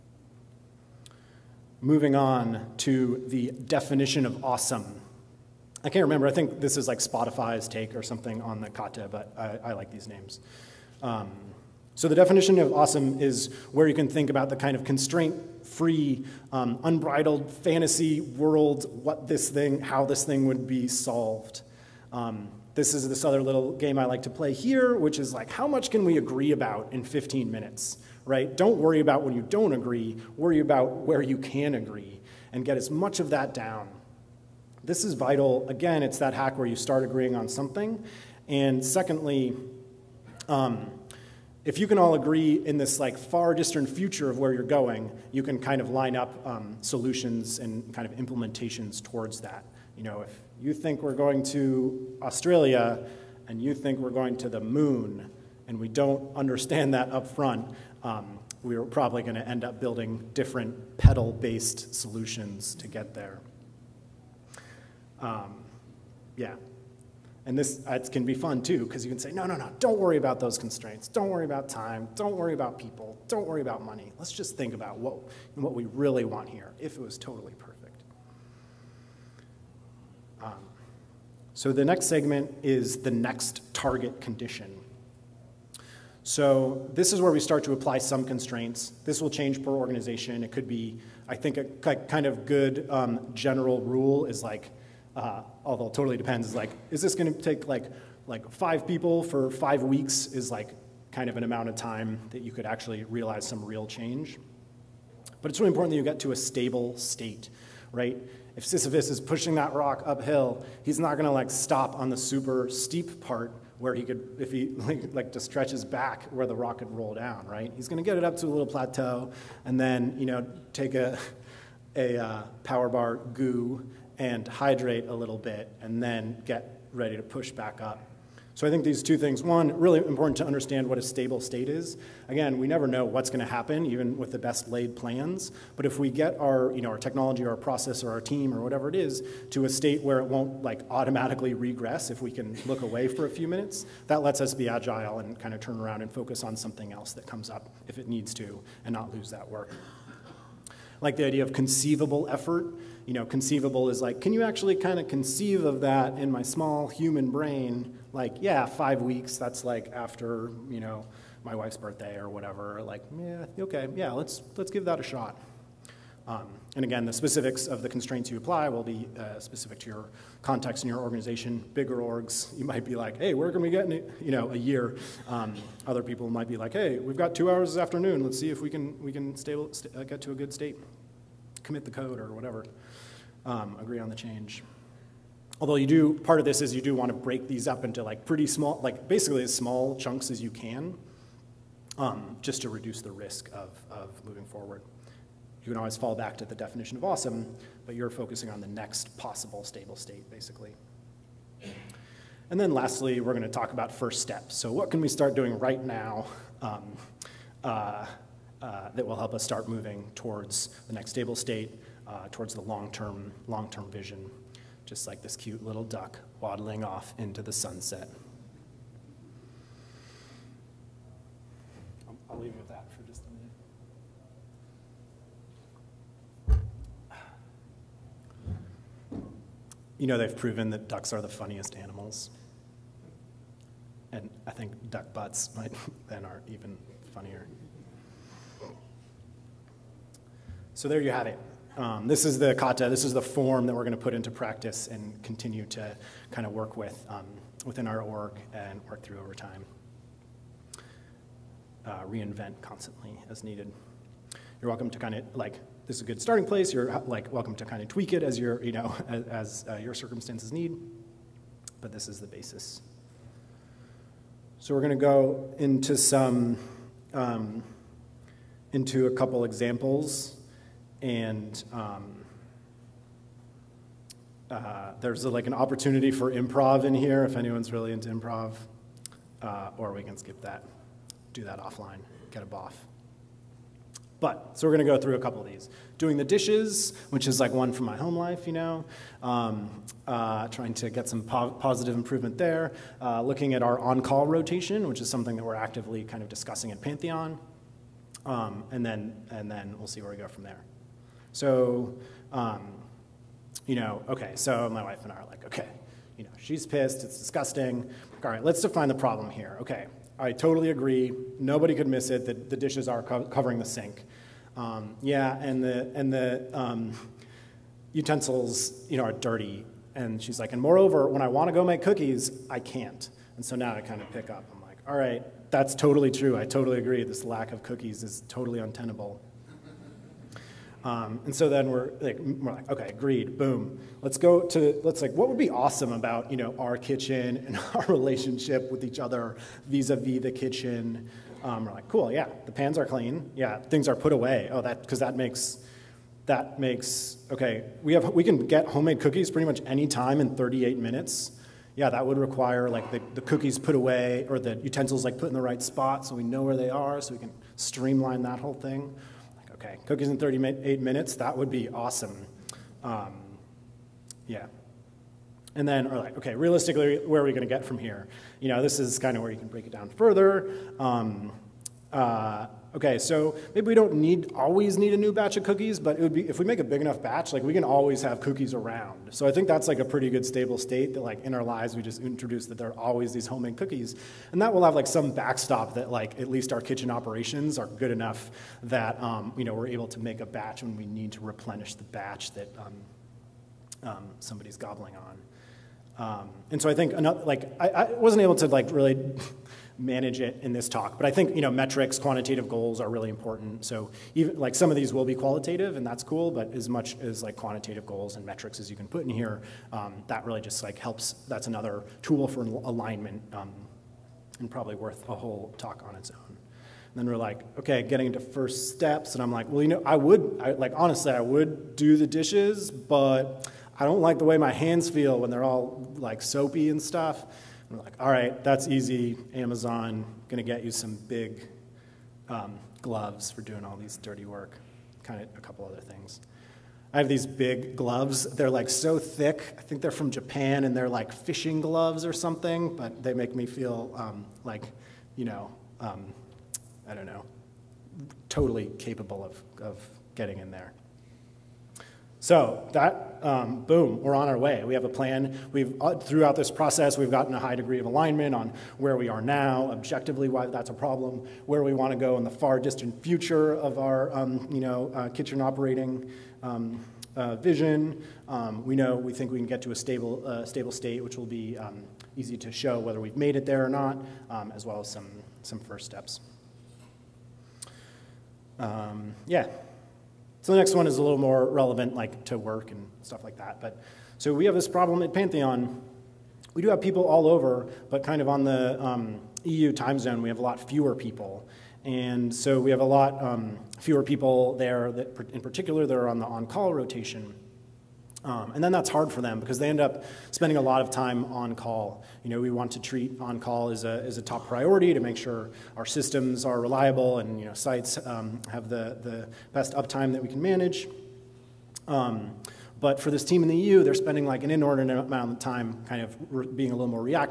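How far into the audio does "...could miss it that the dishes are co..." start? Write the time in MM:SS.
05:11.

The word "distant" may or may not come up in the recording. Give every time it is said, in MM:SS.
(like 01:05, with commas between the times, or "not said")
00:43, 07:42.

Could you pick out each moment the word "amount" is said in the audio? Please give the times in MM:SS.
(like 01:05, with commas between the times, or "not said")
01:41, 08:34.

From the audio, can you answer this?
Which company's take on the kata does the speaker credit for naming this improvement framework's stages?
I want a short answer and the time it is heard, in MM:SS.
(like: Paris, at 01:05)
Spotify, at 00:06.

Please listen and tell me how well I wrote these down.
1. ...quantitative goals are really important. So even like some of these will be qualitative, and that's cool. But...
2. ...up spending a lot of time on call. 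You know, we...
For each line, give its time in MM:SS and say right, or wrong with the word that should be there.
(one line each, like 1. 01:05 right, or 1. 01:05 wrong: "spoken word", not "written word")
1. 06:41 right
2. 08:19 right.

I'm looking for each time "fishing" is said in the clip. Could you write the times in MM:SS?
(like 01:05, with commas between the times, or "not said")
07:21.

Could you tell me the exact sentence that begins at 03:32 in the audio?
uh, towards the long-term, long-term vision, just like this cute little duck waddling off into the sunset.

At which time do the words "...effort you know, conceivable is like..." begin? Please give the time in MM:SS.
02:32.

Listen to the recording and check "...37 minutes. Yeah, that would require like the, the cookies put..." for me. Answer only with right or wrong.
wrong.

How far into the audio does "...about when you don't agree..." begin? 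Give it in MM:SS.
00:29.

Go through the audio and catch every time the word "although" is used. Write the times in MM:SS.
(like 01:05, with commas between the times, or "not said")
01:35, 03:05.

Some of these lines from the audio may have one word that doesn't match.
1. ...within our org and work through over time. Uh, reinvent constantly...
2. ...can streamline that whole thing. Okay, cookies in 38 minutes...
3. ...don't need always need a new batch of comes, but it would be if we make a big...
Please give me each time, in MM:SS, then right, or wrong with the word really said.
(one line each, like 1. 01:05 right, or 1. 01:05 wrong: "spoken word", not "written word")
1. 04:07 right
2. 05:57 right
3. 06:13 wrong: "cookies", not "comes".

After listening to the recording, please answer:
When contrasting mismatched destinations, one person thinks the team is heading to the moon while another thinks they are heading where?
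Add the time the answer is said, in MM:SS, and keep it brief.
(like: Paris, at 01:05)
Australia, at 00:52.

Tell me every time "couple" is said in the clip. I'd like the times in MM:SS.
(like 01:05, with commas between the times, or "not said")
04:29, 04:45, 07:15.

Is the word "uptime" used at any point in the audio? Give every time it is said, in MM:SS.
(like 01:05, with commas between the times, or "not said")
08:29.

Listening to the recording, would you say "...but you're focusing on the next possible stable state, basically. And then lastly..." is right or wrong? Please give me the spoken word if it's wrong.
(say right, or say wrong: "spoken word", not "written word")
right.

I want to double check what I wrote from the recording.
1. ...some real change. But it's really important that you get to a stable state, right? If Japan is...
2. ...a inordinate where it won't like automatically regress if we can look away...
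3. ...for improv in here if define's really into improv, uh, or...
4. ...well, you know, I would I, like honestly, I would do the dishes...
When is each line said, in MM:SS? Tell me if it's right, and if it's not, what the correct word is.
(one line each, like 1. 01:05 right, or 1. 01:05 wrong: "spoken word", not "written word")
1. 01:43 wrong: "Sisyphus", not "Japan"
2. 02:19 wrong: "state", not "inordinate"
3. 04:36 wrong: "anyone", not "define"
4. 06:59 right.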